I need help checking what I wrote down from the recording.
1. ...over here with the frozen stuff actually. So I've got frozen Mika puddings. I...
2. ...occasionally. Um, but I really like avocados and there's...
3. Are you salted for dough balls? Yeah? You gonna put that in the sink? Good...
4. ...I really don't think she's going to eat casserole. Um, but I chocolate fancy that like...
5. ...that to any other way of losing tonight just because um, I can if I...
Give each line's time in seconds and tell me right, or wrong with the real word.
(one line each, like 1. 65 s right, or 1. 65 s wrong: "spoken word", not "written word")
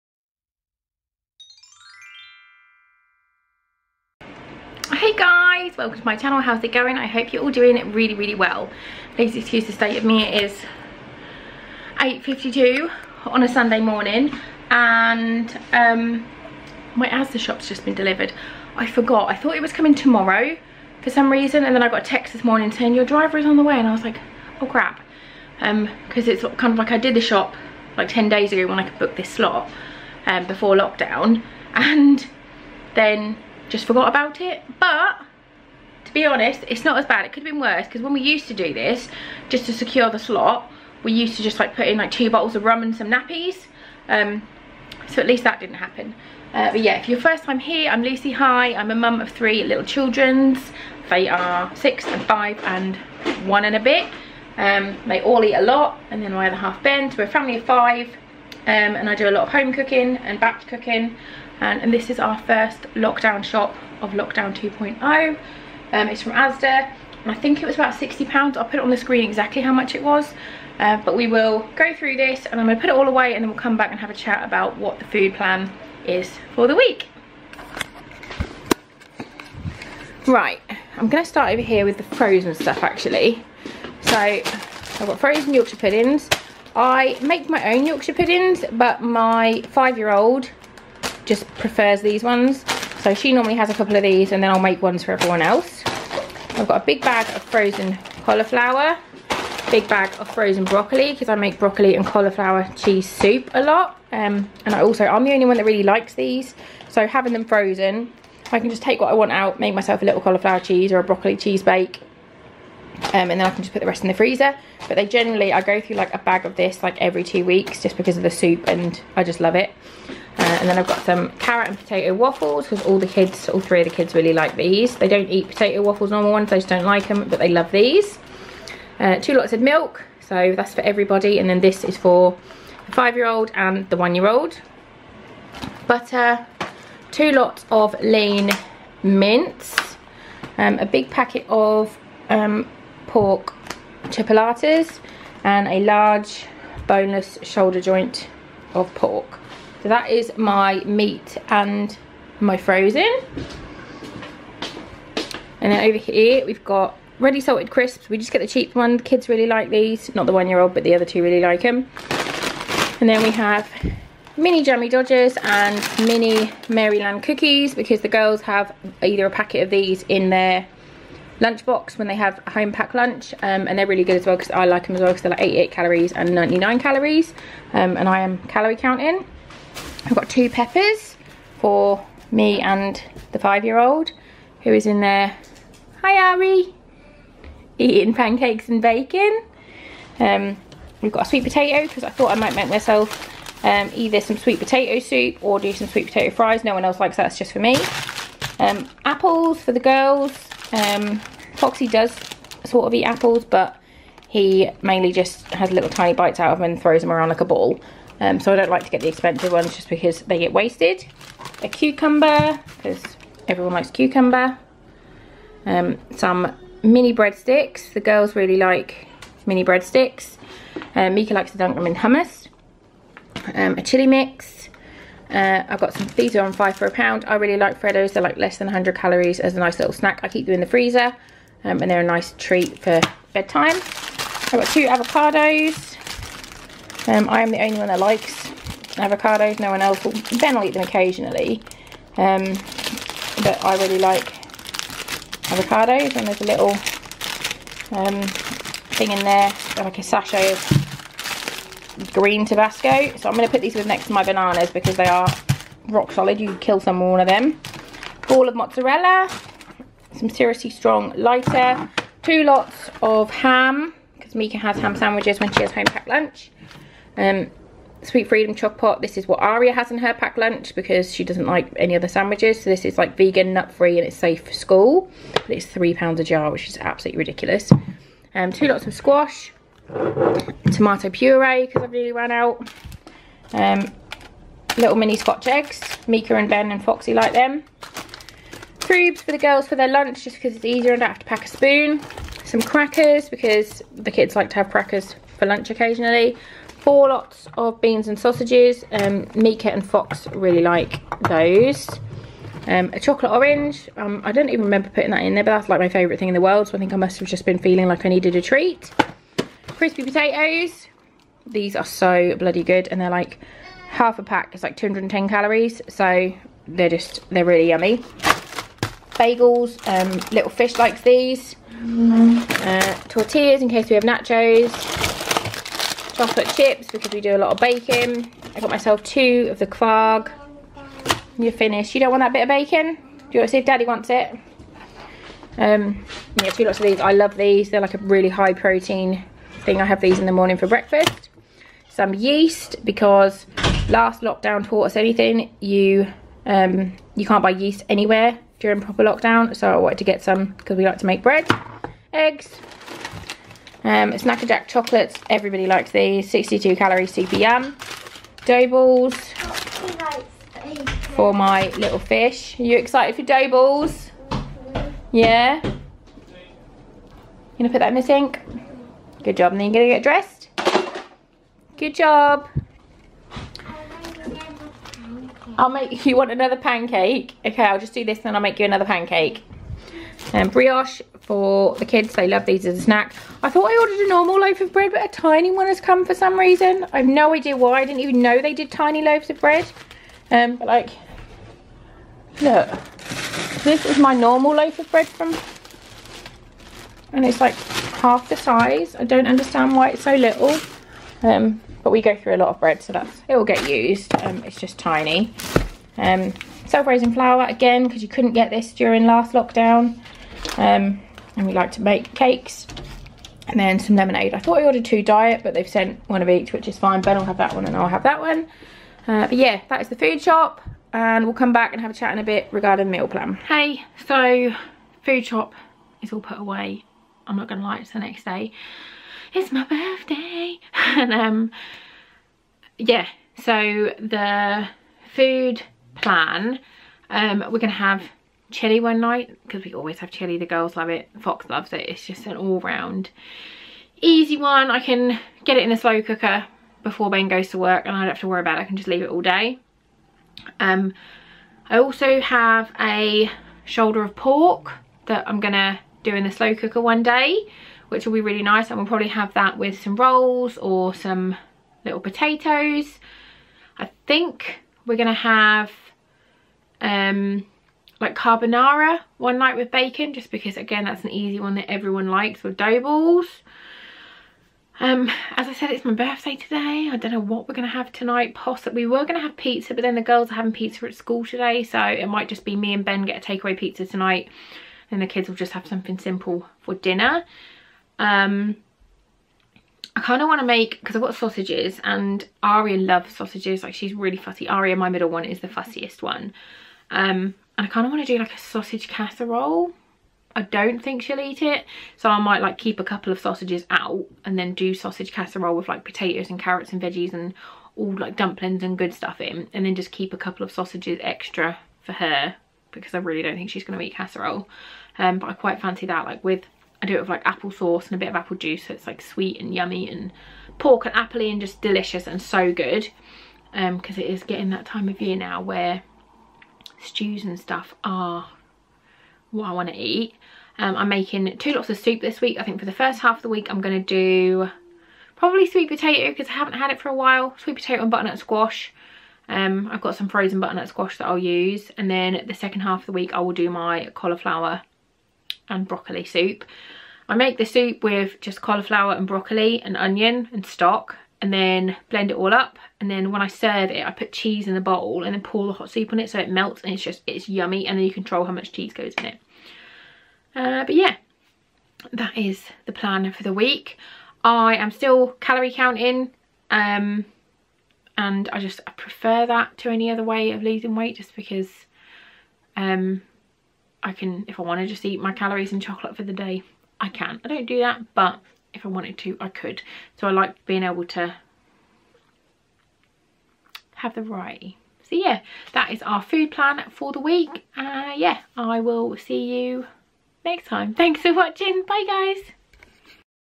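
1. 81 s wrong: "Yorkshire", not "Mika"
2. 240 s right
3. 362 s wrong: "excited", not "salted"
4. 512 s wrong: "quite", not "chocolate"
5. 569 s wrong: "weight", not "tonight".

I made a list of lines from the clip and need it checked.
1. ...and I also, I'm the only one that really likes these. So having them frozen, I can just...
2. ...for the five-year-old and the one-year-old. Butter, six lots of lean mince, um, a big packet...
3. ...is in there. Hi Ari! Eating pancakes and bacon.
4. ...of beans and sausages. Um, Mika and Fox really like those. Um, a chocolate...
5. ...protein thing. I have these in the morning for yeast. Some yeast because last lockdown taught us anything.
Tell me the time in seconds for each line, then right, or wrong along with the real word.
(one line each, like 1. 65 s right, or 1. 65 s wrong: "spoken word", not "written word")
1. 104 s right
2. 131 s wrong: "two", not "six"
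3. 184 s right
4. 297 s right
5. 338 s wrong: "breakfast", not "yeast".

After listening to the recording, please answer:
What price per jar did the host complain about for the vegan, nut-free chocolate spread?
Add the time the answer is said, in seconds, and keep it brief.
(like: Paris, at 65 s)
£3, at 275 s.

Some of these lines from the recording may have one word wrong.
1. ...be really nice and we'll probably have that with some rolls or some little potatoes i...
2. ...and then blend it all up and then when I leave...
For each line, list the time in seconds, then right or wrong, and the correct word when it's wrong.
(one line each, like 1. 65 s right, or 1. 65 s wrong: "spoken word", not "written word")
1. 458 s right
2. 551 s wrong: "serve", not "leave".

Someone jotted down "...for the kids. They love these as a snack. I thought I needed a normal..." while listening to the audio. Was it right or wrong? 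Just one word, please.
wrong.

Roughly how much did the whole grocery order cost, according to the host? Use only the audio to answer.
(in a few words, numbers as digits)
£60.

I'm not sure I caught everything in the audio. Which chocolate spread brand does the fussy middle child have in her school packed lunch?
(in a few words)
Sweet Freedom Choc Pot.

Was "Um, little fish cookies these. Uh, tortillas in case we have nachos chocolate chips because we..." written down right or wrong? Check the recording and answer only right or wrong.
wrong.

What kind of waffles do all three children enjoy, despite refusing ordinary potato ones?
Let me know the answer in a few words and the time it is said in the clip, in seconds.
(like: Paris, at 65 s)
carrot and potato waffles, at 121 s.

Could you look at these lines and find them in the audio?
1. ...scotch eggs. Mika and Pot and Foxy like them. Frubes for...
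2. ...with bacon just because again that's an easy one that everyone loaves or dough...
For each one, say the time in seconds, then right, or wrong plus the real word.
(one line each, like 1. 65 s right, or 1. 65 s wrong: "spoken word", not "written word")
1. 285 s wrong: "Ben", not "Pot"
2. 469 s wrong: "likes", not "loaves".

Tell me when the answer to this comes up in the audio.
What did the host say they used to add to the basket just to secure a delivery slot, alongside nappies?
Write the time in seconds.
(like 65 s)
42 s.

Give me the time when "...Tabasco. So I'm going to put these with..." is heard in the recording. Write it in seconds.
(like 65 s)
252 s.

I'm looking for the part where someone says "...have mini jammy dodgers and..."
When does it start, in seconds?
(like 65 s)
163 s.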